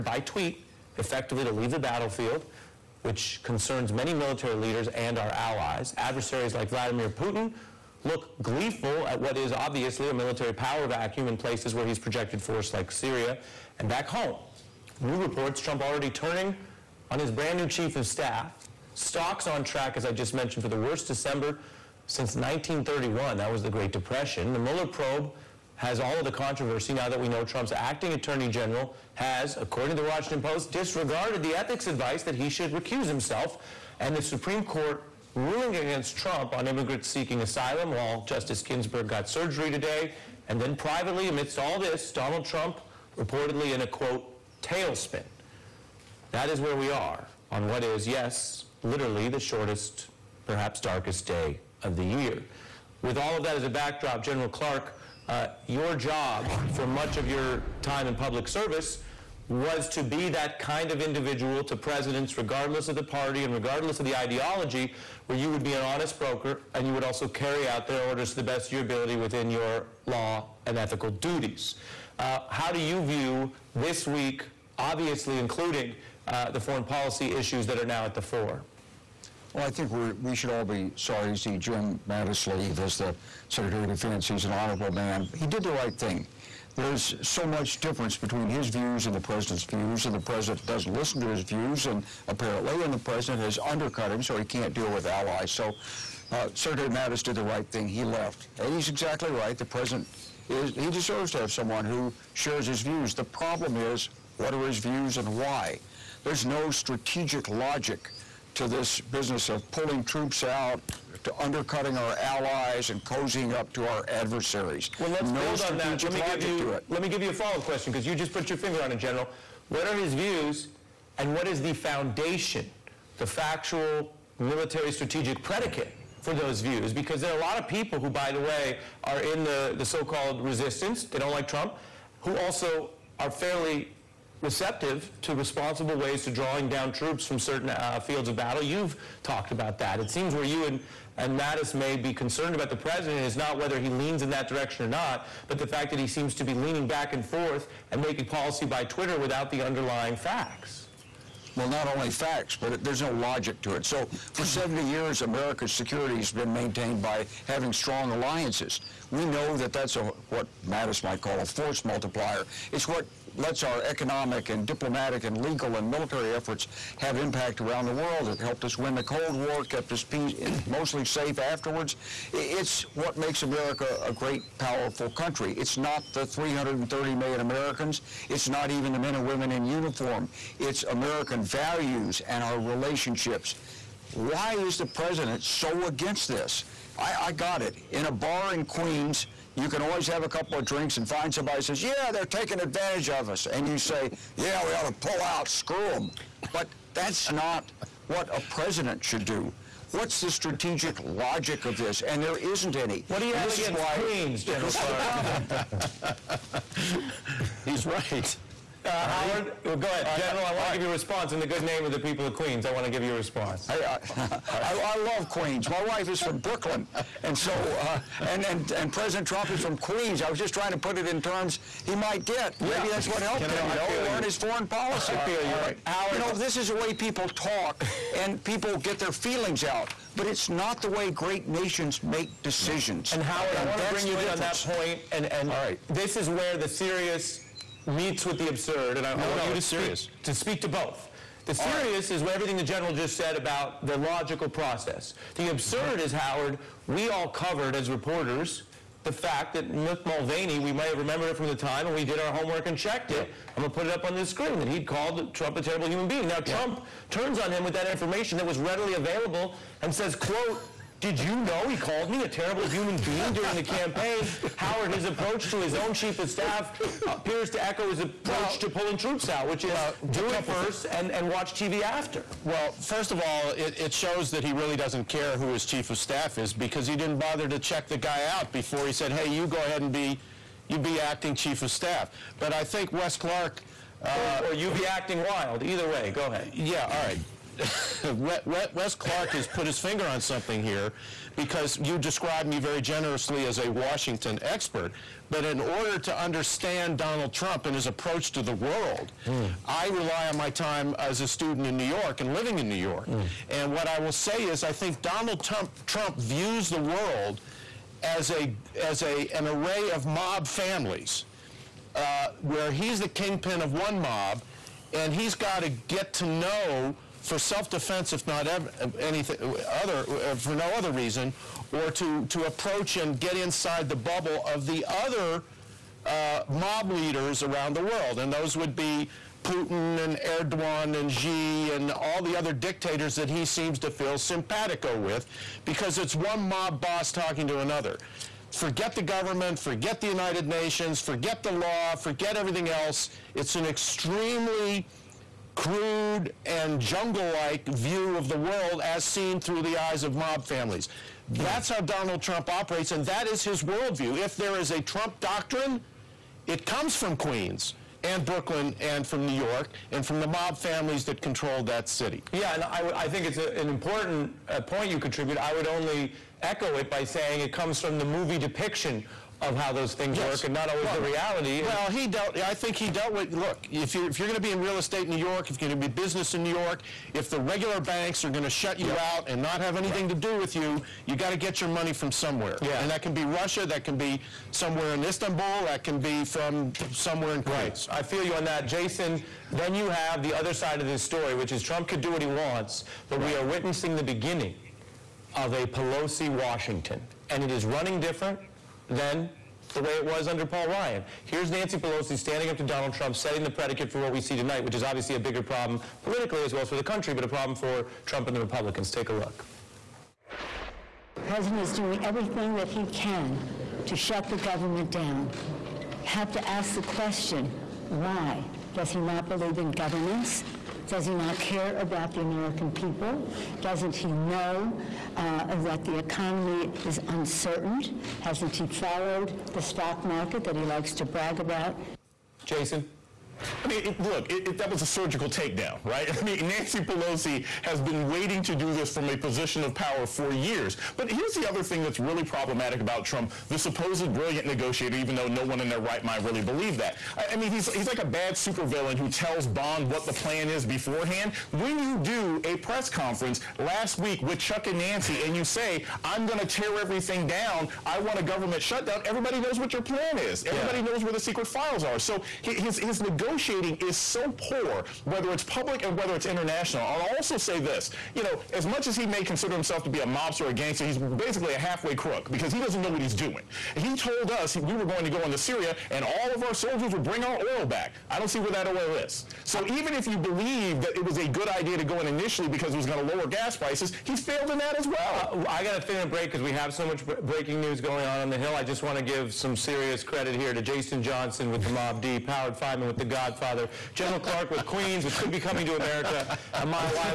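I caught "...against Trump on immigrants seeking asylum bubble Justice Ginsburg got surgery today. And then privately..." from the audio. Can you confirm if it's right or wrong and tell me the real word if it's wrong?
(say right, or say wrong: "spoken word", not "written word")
wrong: "while", not "bubble".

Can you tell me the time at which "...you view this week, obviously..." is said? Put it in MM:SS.
01:12.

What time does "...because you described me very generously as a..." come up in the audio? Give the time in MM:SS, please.
04:51.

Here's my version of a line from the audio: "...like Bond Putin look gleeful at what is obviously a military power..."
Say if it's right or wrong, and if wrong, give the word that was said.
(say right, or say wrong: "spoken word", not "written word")
wrong: "Vladimir", not "Bond".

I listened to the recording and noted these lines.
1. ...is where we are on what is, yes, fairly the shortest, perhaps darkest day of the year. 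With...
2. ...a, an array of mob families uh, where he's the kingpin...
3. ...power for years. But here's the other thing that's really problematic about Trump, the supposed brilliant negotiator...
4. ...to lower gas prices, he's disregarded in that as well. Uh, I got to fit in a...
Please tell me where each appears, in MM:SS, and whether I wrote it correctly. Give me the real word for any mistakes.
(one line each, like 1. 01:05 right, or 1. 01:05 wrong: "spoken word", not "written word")
1. 00:46 wrong: "literally", not "fairly"
2. 05:09 right
3. 07:19 right
4. 08:03 wrong: "failed", not "disregarded".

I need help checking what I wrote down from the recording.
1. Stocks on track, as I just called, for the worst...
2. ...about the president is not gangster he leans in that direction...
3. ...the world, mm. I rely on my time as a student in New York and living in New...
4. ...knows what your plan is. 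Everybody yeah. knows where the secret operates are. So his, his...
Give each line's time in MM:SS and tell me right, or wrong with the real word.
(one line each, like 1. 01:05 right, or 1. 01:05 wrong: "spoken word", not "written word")
1. 00:18 wrong: "mentioned", not "called"
2. 02:22 wrong: "whether", not "gangster"
3. 04:58 right
4. 07:39 wrong: "files", not "operates".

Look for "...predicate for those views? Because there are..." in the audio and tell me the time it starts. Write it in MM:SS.
02:05.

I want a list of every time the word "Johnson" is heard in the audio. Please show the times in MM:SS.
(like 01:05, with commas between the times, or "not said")
08:11.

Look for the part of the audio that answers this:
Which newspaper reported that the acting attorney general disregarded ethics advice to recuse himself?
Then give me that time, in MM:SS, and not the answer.
00:30.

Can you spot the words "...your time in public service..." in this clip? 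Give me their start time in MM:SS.
00:57.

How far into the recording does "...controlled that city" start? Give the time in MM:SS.
06:01.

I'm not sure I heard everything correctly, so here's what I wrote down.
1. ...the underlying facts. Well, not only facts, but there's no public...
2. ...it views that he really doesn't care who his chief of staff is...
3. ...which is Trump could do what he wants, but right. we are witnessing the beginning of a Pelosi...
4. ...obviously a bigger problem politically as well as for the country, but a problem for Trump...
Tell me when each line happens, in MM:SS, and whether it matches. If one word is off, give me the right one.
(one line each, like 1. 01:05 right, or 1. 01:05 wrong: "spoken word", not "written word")
1. 02:29 wrong: "logic", not "public"
2. 04:33 wrong: "shows", not "views"
3. 06:31 right
4. 06:44 right.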